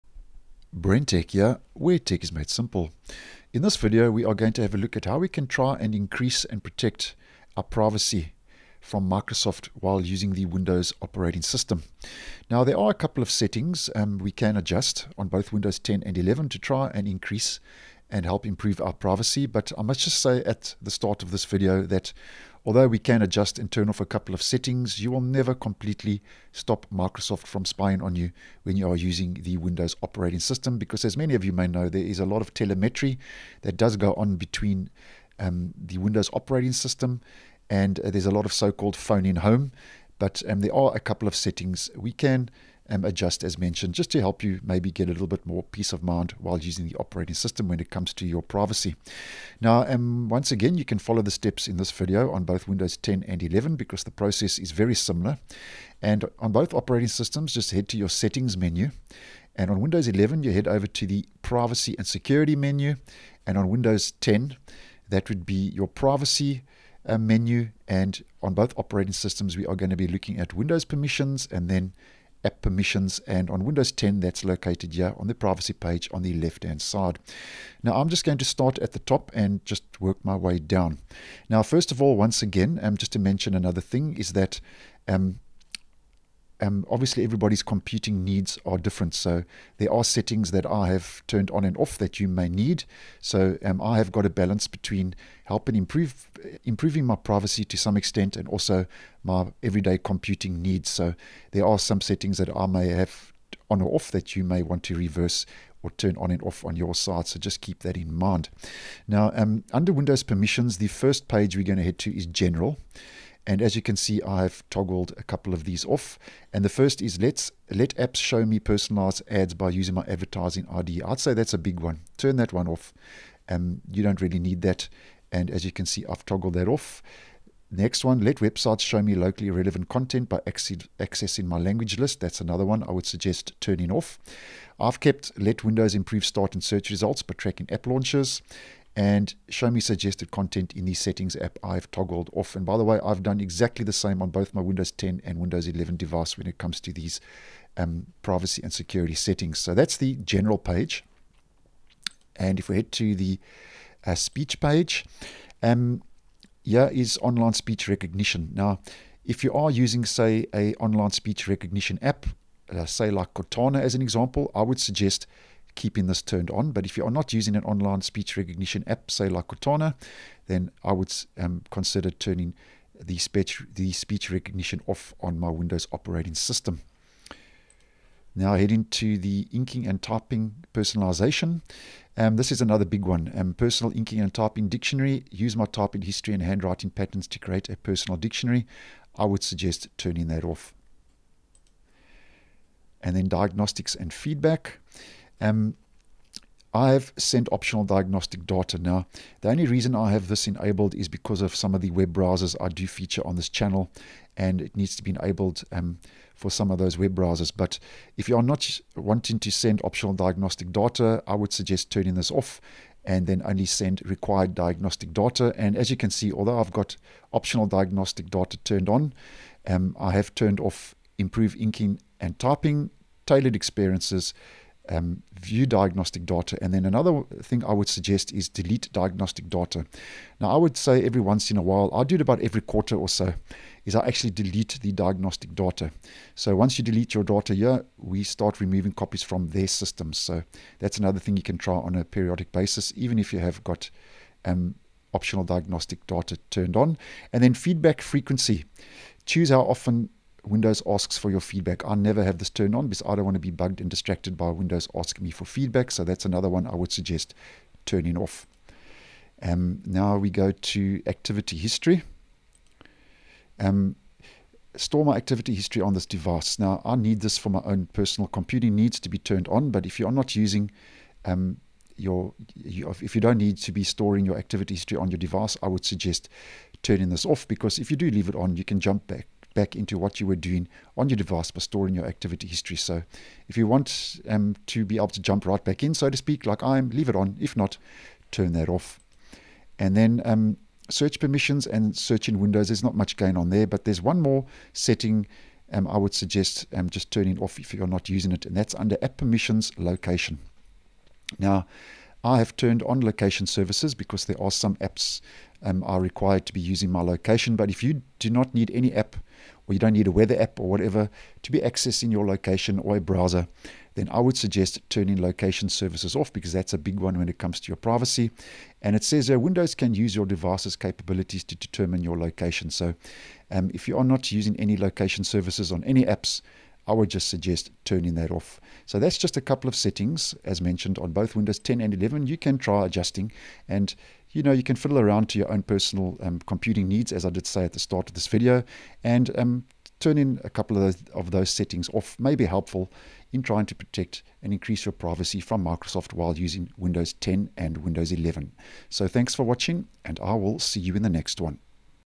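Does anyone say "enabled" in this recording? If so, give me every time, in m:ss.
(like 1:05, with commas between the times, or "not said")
3:20, 3:25.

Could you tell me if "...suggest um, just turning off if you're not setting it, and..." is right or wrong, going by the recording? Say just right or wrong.
wrong.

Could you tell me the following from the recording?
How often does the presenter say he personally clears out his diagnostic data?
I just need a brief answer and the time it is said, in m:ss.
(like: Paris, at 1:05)
Every quarter, at 3:52.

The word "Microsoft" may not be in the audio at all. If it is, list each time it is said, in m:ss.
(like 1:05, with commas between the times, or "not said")
0:09, 0:26, 5:45.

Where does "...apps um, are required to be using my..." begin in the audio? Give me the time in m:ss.
5:04.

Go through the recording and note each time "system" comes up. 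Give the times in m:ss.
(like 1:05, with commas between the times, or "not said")
0:11, 0:30, 0:36, 0:47, 0:57, 1:09, 2:56, 3:59.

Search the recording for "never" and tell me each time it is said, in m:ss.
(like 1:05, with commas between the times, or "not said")
0:25, 4:11.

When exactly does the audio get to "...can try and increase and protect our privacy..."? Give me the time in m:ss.
0:05.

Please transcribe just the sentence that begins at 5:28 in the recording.
So that's just a couple of settings, as mentioned, on both Windows 10 and 11.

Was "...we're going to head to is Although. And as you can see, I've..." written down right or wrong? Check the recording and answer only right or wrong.
wrong.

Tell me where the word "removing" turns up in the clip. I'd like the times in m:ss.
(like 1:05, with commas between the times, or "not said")
3:58.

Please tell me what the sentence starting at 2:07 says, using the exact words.
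Next one, let websites show me locally relevant content by accessing my language list.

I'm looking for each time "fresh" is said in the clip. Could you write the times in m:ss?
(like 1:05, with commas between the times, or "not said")
not said.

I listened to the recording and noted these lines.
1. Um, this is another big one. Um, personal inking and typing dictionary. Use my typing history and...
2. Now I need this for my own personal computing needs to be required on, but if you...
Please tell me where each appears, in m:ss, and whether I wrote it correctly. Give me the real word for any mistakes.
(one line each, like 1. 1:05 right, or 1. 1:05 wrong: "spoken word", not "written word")
1. 3:02 right
2. 4:26 wrong: "turned", not "required".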